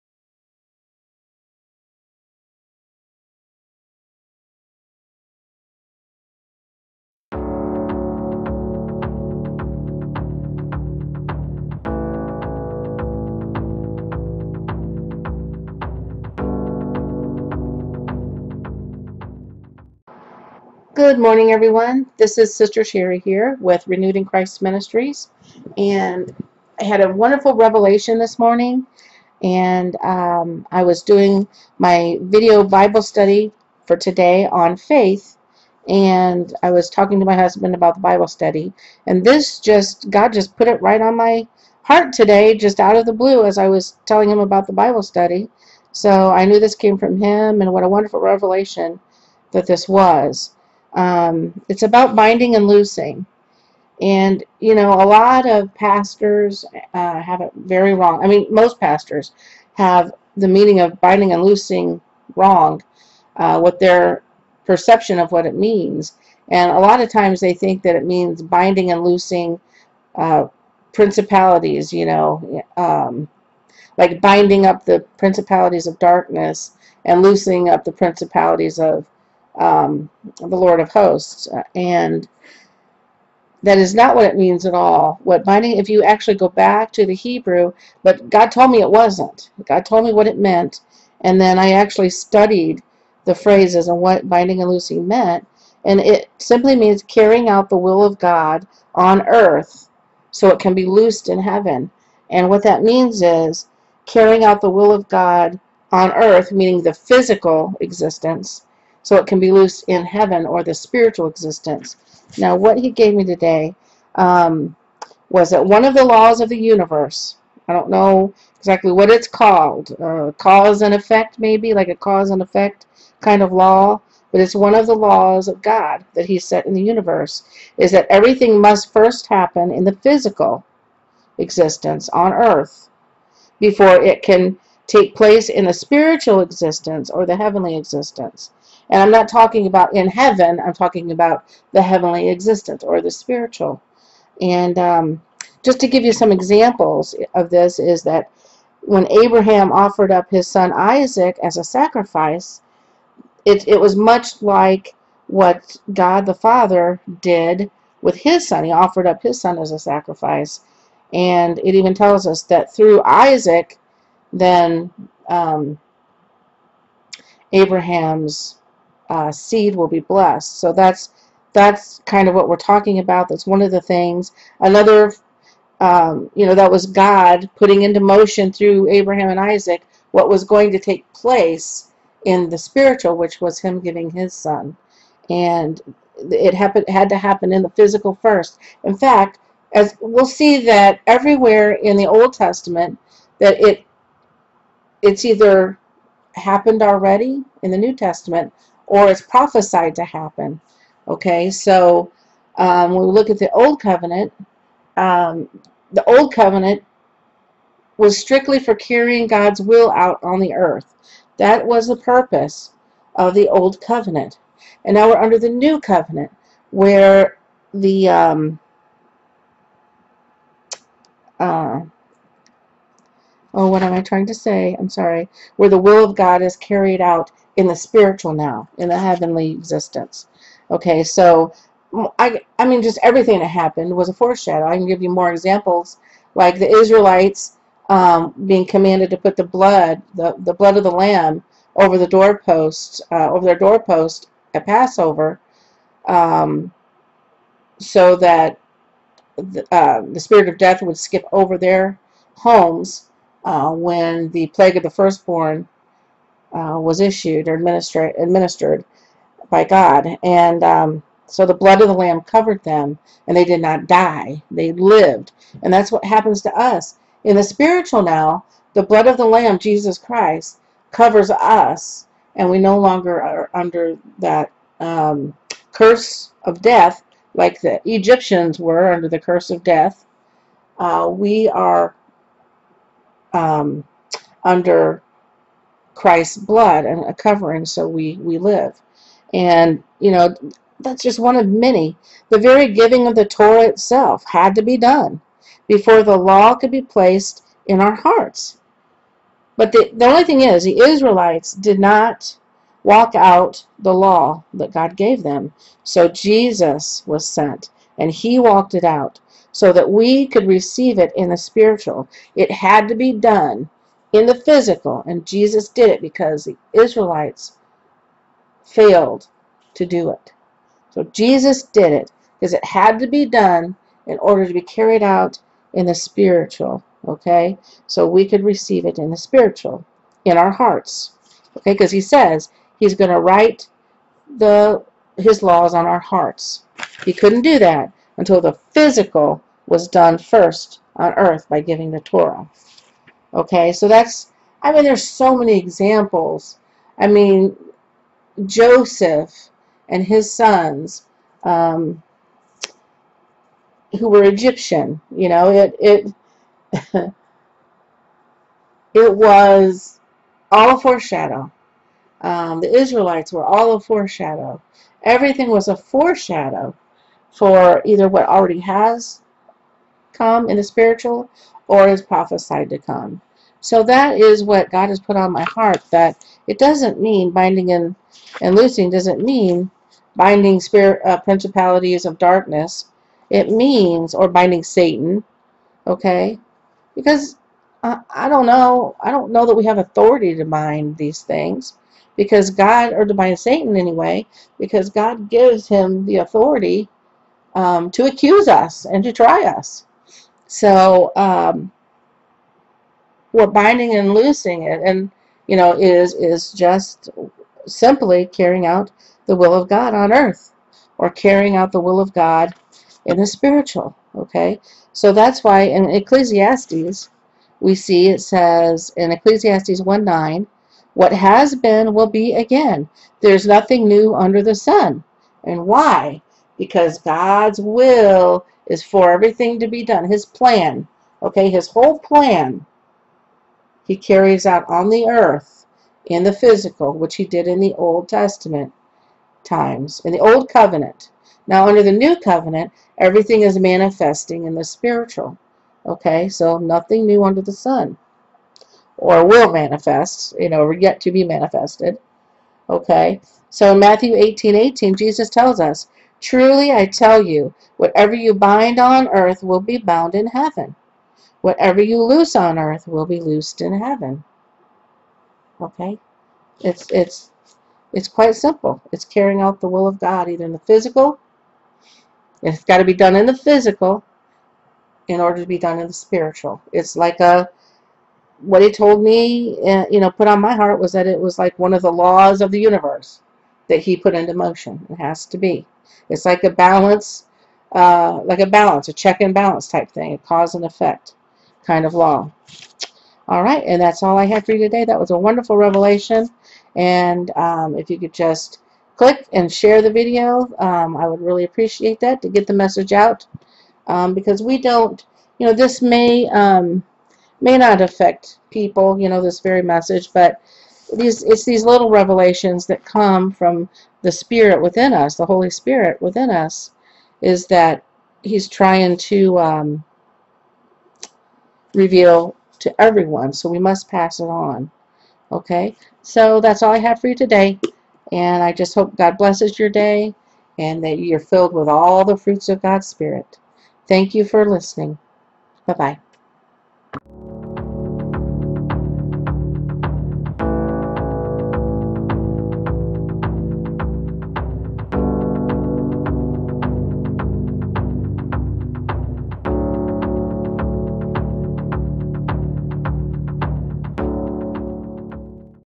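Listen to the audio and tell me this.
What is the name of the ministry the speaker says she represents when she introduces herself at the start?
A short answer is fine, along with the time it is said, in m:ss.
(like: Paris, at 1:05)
Renewed in Christ Ministries, at 0:23.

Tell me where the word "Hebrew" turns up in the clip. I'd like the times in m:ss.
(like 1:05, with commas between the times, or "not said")
1:27.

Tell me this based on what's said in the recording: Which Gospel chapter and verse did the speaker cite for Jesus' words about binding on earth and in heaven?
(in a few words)
Matthew 18:18.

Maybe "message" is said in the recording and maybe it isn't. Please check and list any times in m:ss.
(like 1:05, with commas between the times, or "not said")
8:22, 8:29.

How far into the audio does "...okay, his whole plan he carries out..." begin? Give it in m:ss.
7:11.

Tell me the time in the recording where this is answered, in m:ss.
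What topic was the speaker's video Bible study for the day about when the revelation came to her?
0:34.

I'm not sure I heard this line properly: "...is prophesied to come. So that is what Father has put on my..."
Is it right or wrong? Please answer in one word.
wrong.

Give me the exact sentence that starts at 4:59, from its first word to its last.
But the, the only thing is, the Israelites did not walk out the law that God gave them.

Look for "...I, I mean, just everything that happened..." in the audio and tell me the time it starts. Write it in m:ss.
3:52.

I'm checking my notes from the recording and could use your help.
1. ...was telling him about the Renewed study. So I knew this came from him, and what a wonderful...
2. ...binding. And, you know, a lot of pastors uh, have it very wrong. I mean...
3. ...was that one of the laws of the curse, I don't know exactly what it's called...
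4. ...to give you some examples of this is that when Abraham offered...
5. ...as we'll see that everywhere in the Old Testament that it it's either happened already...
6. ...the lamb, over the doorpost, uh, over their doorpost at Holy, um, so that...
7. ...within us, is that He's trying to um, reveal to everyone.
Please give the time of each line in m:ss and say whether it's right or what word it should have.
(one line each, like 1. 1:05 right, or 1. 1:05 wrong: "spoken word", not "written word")
1. 0:43 wrong: "Bible", not "Renewed"
2. 0:52 wrong: "loosing", not "binding"
3. 1:55 wrong: "universe", not "curse"
4. 2:25 right
5. 3:09 right
6. 4:00 wrong: "Passover", not "Holy"
7. 8:36 right.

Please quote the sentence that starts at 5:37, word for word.
He couldn't do that until the physical was done first on earth by giving the Torah.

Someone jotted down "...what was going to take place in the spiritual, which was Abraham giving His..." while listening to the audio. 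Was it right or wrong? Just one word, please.
wrong.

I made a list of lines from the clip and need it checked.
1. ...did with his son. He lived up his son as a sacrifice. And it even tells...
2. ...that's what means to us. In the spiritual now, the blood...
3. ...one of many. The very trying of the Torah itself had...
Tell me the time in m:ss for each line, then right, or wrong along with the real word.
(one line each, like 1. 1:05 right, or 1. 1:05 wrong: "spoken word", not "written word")
1. 2:37 wrong: "offered", not "lived"
2. 4:25 wrong: "happens", not "means"
3. 4:51 wrong: "giving", not "trying".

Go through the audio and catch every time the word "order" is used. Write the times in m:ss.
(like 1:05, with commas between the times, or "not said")
5:24, 7:55.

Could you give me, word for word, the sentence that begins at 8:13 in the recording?
All right, and that's all I had for you today.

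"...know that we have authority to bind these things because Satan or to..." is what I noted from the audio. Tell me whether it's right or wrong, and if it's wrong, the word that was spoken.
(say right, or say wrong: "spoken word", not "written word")
wrong: "God", not "Satan".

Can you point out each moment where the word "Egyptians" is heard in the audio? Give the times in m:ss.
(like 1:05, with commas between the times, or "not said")
4:37, 5:54.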